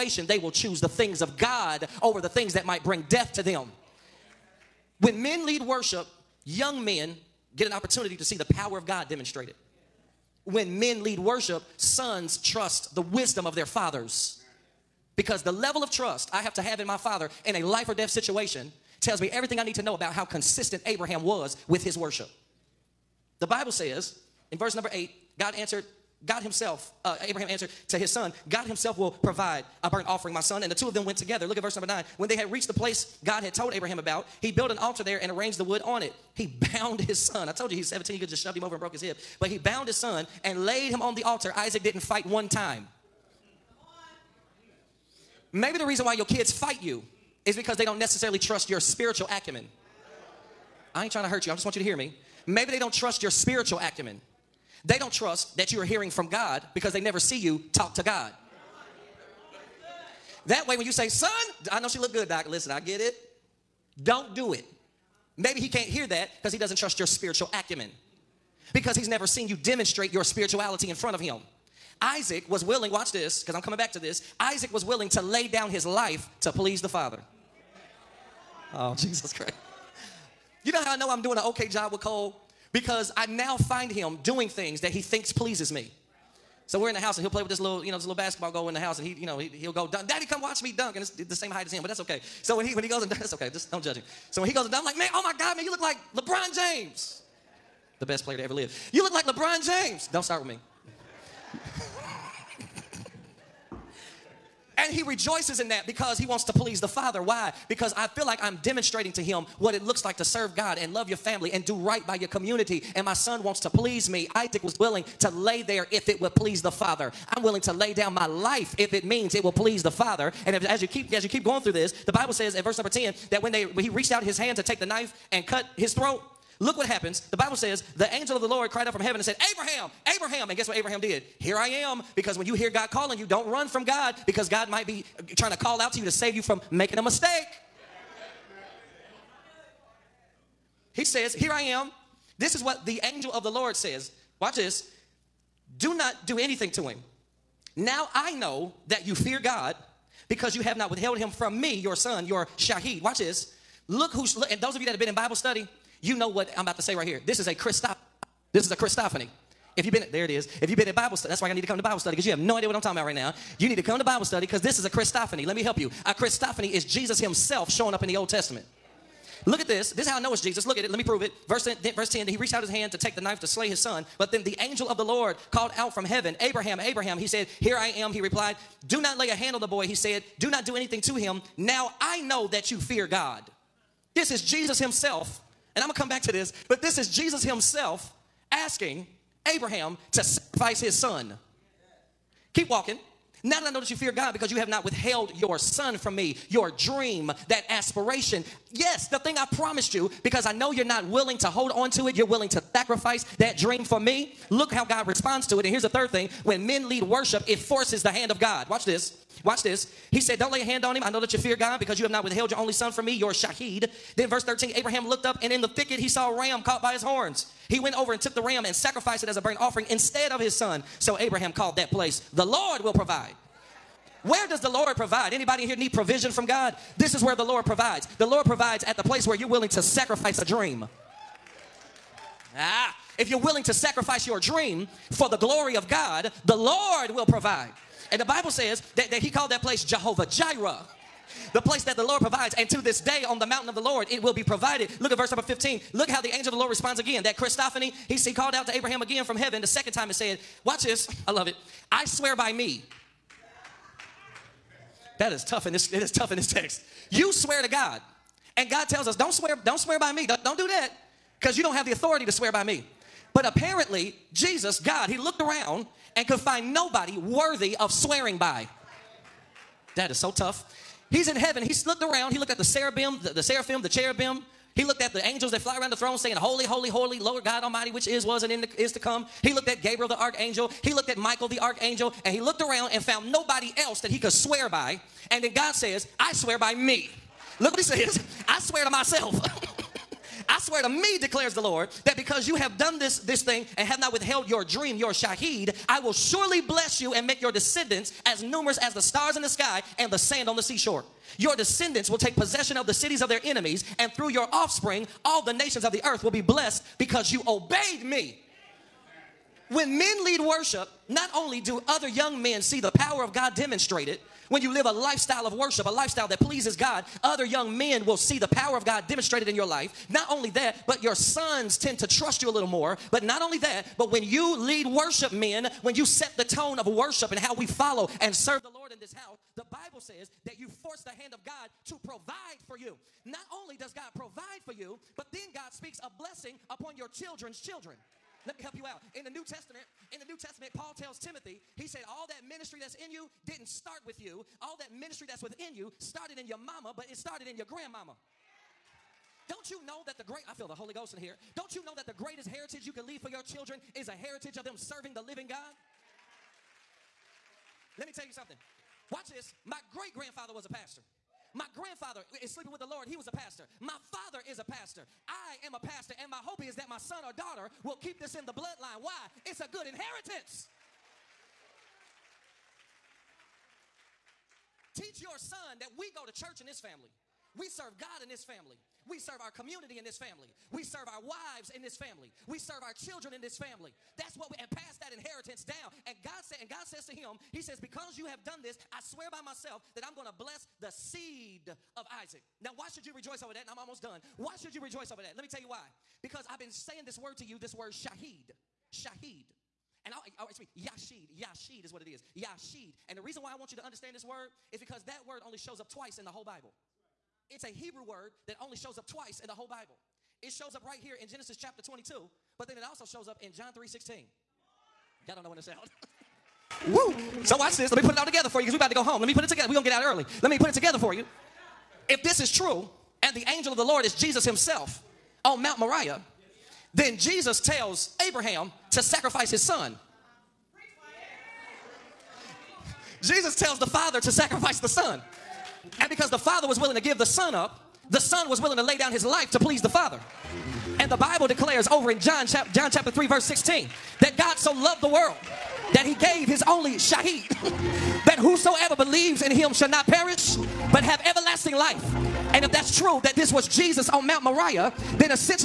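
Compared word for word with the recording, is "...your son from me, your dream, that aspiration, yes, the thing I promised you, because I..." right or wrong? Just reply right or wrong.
right.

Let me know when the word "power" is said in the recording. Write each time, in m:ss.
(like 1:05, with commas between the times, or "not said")
0:08, 5:12, 5:18.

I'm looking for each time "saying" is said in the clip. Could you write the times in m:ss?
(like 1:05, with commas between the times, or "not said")
4:36, 6:36.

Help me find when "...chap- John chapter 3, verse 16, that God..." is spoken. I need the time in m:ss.
7:22.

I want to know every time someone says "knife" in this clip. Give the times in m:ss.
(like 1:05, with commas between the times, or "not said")
2:04, 2:53.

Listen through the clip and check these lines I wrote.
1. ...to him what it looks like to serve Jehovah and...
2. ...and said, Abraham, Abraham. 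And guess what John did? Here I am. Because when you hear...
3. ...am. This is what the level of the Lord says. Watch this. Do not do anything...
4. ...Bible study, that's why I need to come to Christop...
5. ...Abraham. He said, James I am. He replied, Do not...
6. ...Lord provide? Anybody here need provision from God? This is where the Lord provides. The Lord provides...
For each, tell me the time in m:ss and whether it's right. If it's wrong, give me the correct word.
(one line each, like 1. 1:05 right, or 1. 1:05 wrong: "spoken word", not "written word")
1. 1:49 wrong: "God", not "Jehovah"
2. 2:09 wrong: "Abraham", not "John"
3. 2:21 wrong: "angel", not "level"
4. 2:40 wrong: "Bible", not "Christop"
5. 2:56 wrong: "Here", not "James"
6. 3:44 right.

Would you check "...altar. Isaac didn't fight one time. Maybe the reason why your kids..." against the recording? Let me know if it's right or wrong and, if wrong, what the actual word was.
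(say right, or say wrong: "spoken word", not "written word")
right.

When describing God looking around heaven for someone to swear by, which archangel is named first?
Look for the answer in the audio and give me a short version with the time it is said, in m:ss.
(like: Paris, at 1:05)
Gabriel, at 4:39.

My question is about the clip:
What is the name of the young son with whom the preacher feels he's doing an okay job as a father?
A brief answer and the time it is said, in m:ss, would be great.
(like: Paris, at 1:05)
Cole, at 1:21.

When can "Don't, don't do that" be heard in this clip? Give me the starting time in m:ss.
4:20.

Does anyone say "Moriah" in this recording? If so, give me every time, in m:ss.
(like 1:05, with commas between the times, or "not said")
7:05, 7:34.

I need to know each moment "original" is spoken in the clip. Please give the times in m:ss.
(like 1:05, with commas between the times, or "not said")
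not said.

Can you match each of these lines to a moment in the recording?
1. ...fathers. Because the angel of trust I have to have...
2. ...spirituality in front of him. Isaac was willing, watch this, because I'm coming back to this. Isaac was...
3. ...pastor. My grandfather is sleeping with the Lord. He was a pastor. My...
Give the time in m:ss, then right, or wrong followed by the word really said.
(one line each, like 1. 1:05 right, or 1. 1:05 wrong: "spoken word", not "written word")
1. 0:13 wrong: "level", not "angel"
2. 1:10 right
3. 6:00 right.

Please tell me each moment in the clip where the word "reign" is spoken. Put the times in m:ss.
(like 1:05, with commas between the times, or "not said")
not said.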